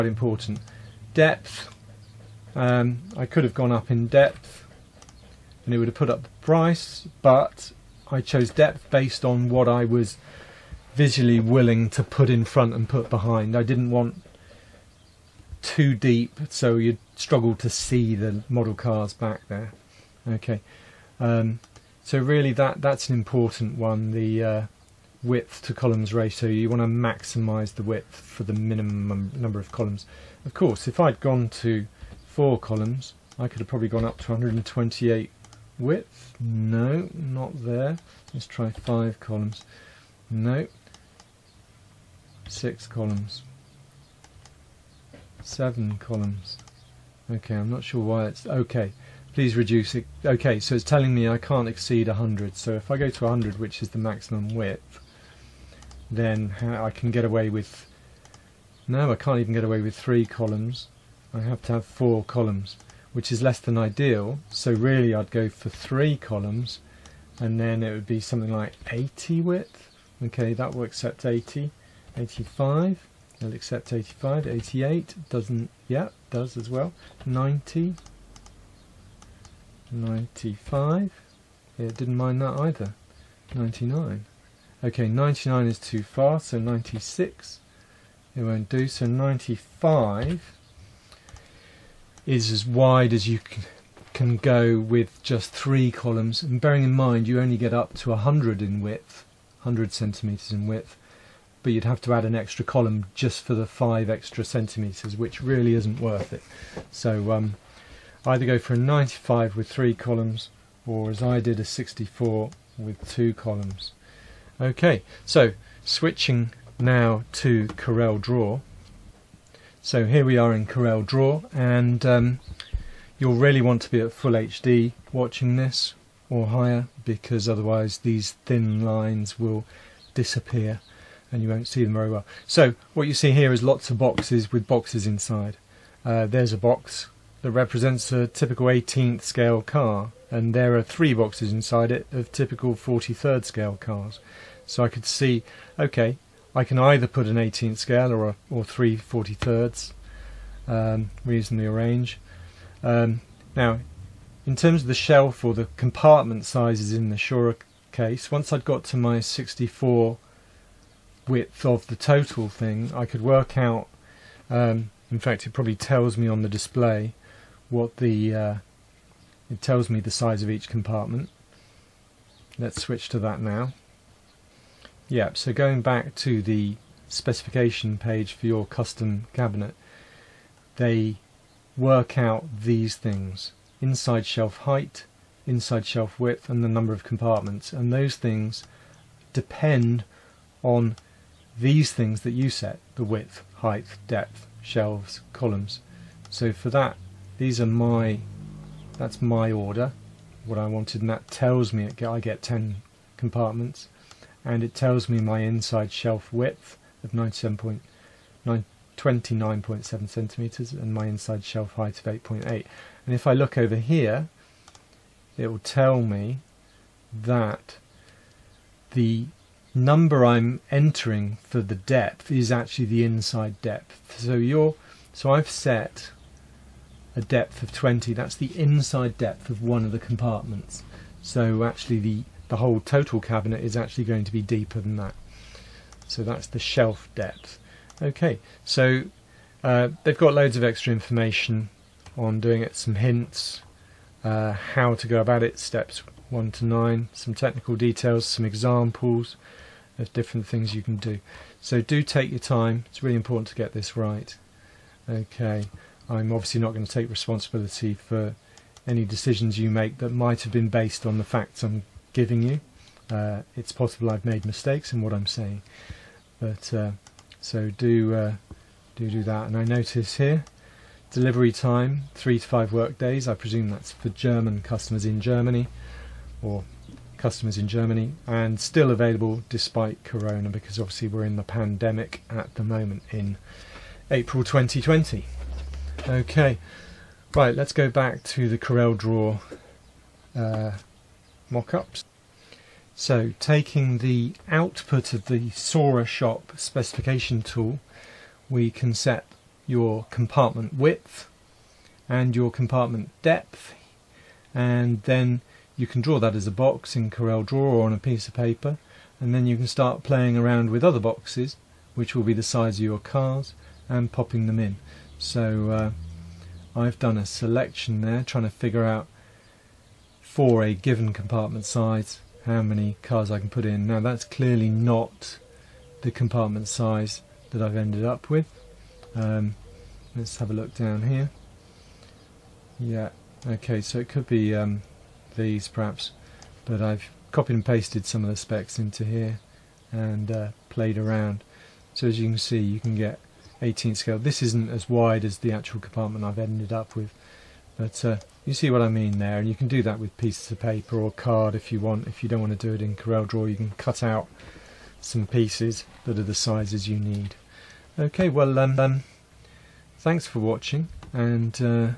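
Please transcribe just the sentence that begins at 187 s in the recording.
And those things depend on these things that you set the width, height, depth, shelves, columns.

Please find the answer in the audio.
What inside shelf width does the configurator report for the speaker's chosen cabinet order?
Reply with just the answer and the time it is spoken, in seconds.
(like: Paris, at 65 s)
29.7 centimeters, at 207 s.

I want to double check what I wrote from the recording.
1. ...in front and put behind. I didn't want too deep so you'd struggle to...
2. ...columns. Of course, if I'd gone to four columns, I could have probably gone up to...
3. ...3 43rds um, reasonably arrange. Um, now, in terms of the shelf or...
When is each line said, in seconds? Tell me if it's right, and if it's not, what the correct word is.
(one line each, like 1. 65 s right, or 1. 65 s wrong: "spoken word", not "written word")
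1. 12 s right
2. 29 s right
3. 148 s right.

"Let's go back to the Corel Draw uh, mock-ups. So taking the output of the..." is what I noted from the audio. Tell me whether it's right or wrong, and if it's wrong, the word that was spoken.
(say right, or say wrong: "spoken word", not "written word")
right.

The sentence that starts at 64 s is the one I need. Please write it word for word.
So really I'd go for three columns and then it would be something like 80 width.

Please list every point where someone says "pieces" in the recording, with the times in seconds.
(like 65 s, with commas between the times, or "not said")
307 s, 350 s, 355 s.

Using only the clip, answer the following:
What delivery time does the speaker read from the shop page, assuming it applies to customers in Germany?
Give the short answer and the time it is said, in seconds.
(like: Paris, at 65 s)
3 to 5 work days, at 272 s.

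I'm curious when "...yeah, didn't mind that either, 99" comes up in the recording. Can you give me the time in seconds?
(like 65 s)
81 s.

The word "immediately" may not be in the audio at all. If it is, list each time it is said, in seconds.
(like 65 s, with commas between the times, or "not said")
not said.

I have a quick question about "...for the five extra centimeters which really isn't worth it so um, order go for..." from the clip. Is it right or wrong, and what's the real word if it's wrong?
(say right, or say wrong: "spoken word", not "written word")
wrong: "either", not "order".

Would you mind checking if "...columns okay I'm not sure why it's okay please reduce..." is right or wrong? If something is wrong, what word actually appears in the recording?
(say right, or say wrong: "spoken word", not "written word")
right.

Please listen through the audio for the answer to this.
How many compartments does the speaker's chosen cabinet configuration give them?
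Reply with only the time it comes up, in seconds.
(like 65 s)
202 s.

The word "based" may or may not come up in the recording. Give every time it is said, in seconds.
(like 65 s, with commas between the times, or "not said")
8 s, 260 s.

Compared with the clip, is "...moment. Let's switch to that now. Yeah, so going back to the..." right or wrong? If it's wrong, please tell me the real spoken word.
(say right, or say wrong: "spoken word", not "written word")
wrong: "compartment", not "moment".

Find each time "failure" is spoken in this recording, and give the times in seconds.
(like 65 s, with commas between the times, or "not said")
not said.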